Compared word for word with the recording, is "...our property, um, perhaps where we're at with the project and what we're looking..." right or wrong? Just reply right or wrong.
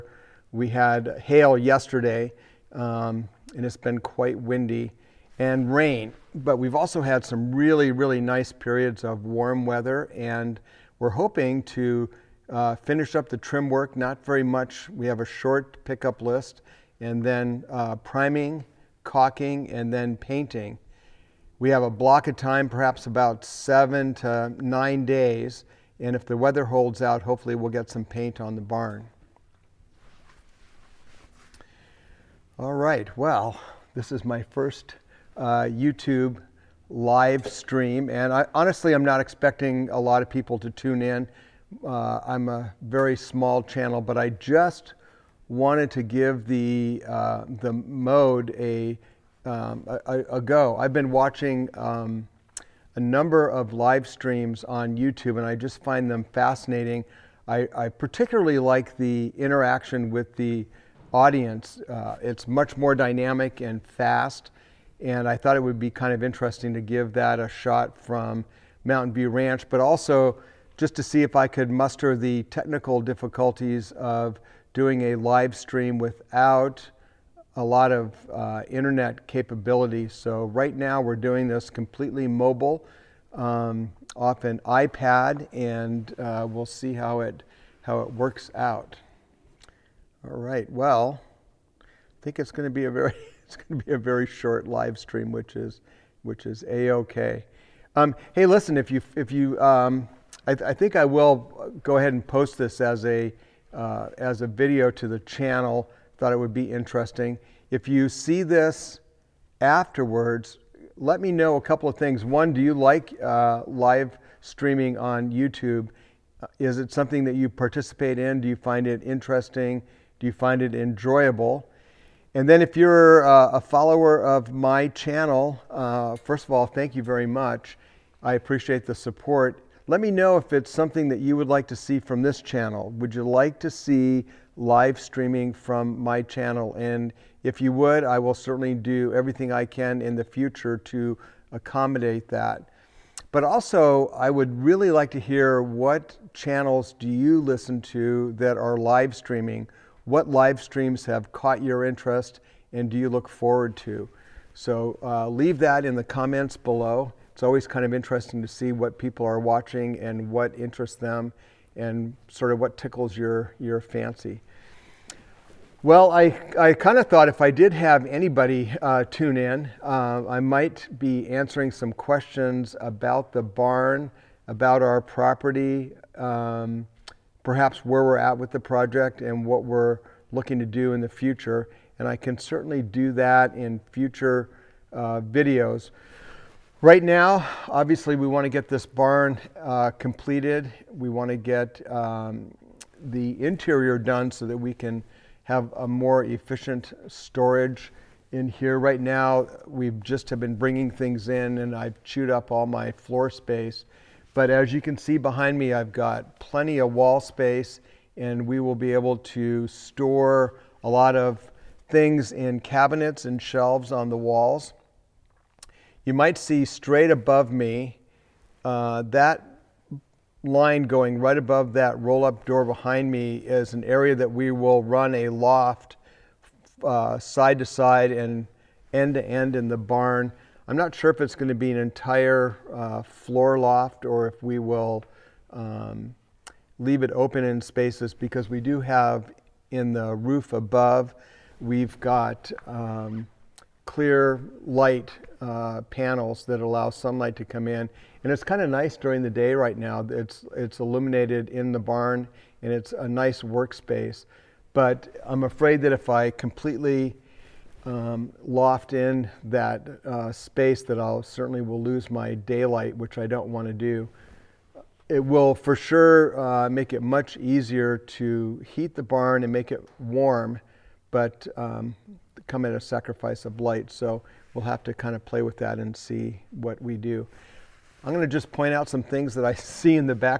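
right.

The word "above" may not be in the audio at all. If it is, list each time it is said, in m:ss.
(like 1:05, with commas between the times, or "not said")
3:37, 3:41, 4:00.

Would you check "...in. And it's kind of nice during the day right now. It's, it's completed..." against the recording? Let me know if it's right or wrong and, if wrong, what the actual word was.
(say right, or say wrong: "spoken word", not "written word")
wrong: "illuminated", not "completed".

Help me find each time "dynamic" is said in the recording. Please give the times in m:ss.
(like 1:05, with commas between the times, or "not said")
1:02.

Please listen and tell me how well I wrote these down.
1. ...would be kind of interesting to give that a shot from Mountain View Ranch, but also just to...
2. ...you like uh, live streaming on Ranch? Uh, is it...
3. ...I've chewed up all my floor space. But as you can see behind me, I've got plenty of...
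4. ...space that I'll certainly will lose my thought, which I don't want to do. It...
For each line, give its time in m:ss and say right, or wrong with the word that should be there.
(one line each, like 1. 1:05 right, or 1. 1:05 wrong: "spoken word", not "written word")
1. 1:05 right
2. 1:52 wrong: "YouTube", not "Ranch"
3. 3:21 right
4. 4:20 wrong: "daylight", not "thought".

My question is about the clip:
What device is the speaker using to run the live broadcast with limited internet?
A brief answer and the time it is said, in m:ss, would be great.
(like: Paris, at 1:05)
iPad, at 1:24.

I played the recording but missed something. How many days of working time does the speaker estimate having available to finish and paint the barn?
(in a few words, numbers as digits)
7 to 9 days.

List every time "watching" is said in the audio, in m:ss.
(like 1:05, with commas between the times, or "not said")
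0:51, 2:39.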